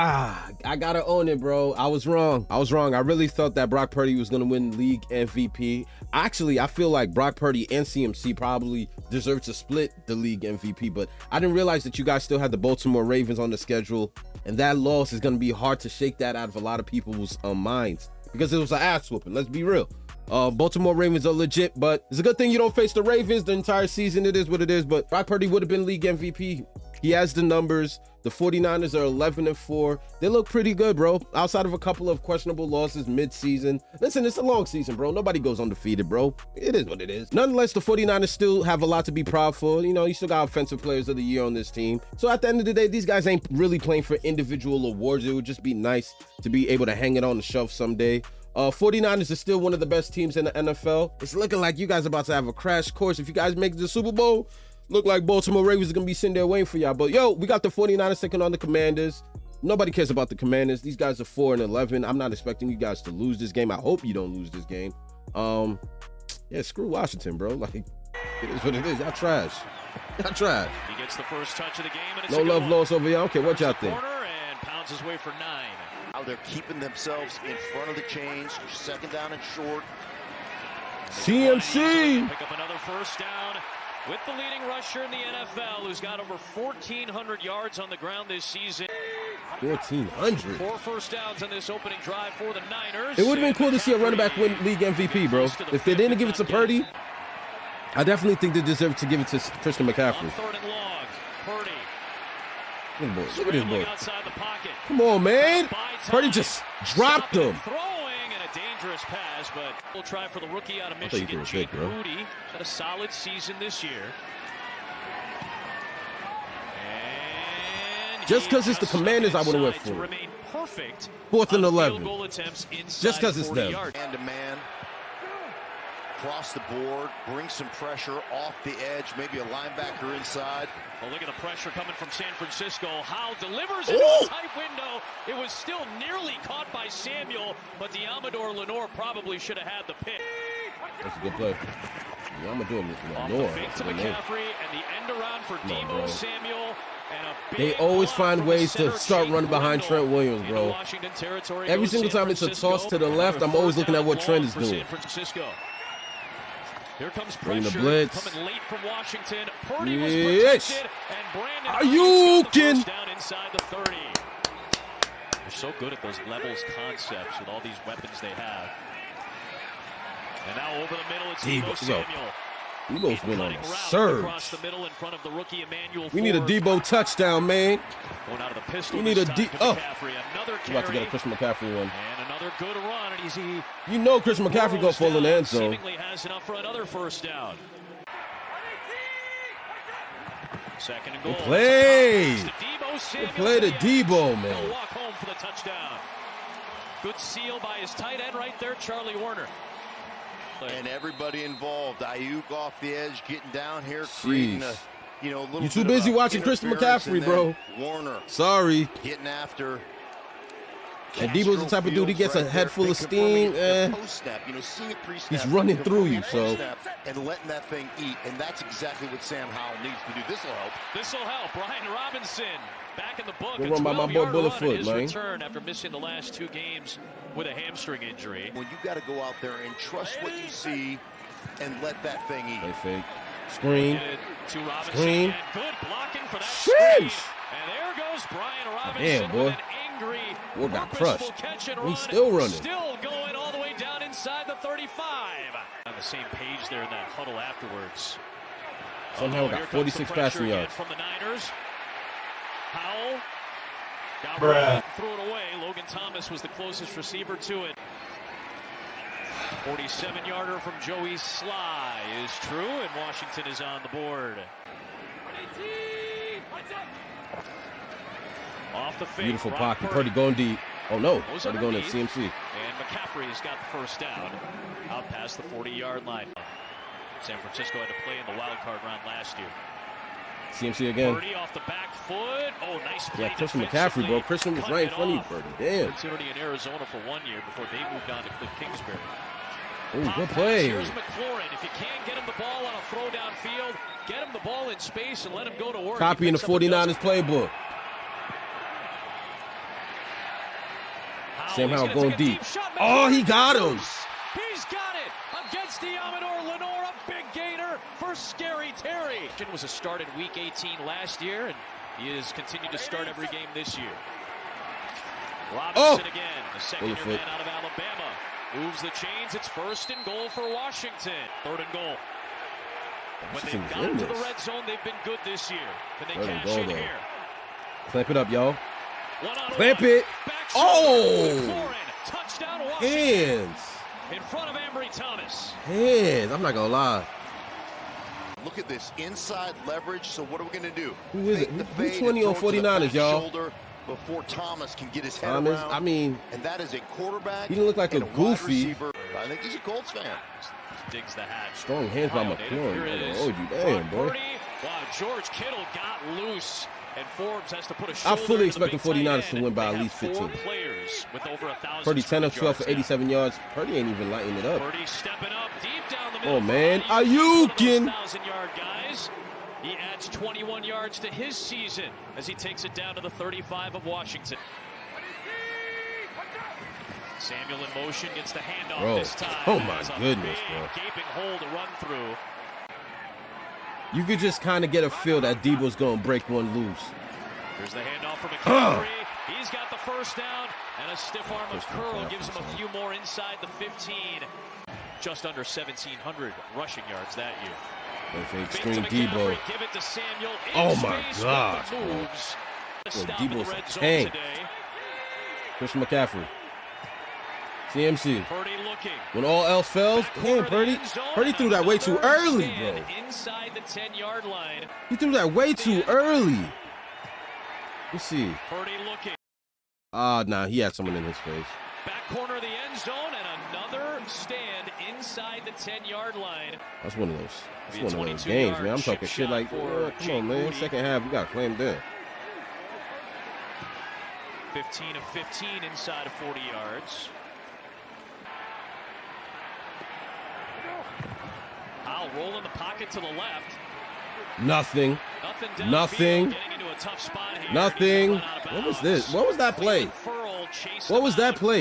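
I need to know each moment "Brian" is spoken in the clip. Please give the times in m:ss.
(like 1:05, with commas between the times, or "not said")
3:41, 3:58.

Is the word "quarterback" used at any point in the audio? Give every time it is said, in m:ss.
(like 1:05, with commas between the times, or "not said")
5:46.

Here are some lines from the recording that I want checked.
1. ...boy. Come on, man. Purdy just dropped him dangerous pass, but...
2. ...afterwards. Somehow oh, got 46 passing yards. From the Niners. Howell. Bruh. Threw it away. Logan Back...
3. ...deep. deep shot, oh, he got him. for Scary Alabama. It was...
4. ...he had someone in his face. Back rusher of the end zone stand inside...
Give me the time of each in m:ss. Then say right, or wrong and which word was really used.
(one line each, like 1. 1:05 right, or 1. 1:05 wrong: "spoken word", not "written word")
1. 1:43 right
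2. 4:07 wrong: "Thomas", not "Back"
3. 5:02 wrong: "Terry", not "Alabama"
4. 7:00 wrong: "corner", not "rusher".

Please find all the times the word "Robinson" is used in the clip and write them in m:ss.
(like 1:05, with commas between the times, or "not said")
3:41, 3:58, 5:15.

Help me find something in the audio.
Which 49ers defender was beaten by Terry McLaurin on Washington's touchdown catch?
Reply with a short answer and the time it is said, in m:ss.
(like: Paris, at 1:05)
Ambry Thomas, at 5:34.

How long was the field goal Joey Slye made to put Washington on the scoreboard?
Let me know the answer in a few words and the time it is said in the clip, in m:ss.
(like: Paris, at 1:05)
47 yards, at 4:19.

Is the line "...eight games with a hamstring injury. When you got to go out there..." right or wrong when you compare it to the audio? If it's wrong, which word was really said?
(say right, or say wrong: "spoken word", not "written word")
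wrong: "two", not "eight".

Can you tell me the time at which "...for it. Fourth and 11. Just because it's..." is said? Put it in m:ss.
1:59.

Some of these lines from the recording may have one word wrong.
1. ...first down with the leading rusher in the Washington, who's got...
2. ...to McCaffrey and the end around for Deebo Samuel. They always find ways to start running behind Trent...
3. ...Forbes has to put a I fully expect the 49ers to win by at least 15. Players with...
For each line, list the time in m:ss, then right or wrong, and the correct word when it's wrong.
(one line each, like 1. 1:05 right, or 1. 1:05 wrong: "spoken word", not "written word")
1. 1:22 wrong: "NFL", not "Washington"
2. 2:23 right
3. 5:57 right.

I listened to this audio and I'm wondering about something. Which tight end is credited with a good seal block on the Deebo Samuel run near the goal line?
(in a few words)
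Charlie Woerner.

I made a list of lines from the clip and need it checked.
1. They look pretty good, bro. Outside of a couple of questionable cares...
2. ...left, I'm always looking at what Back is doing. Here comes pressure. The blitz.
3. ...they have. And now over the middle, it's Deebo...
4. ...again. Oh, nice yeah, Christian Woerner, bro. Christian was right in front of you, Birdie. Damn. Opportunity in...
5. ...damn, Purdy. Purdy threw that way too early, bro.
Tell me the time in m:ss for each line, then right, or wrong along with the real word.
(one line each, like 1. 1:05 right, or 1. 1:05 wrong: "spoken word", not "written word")
1. 0:30 wrong: "losses", not "cares"
2. 2:33 wrong: "Trent", not "Back"
3. 2:48 right
4. 4:40 wrong: "McCaffrey", not "Woerner"
5. 6:50 right.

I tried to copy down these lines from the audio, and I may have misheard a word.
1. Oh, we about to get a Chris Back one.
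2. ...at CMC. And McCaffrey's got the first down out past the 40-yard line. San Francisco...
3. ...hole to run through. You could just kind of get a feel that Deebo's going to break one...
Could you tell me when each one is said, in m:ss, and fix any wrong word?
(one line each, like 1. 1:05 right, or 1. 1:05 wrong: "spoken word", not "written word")
1. 2:59 wrong: "McCaffrey", not "Back"
2. 4:31 right
3. 6:21 right.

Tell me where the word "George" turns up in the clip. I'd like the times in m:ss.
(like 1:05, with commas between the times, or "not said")
5:54.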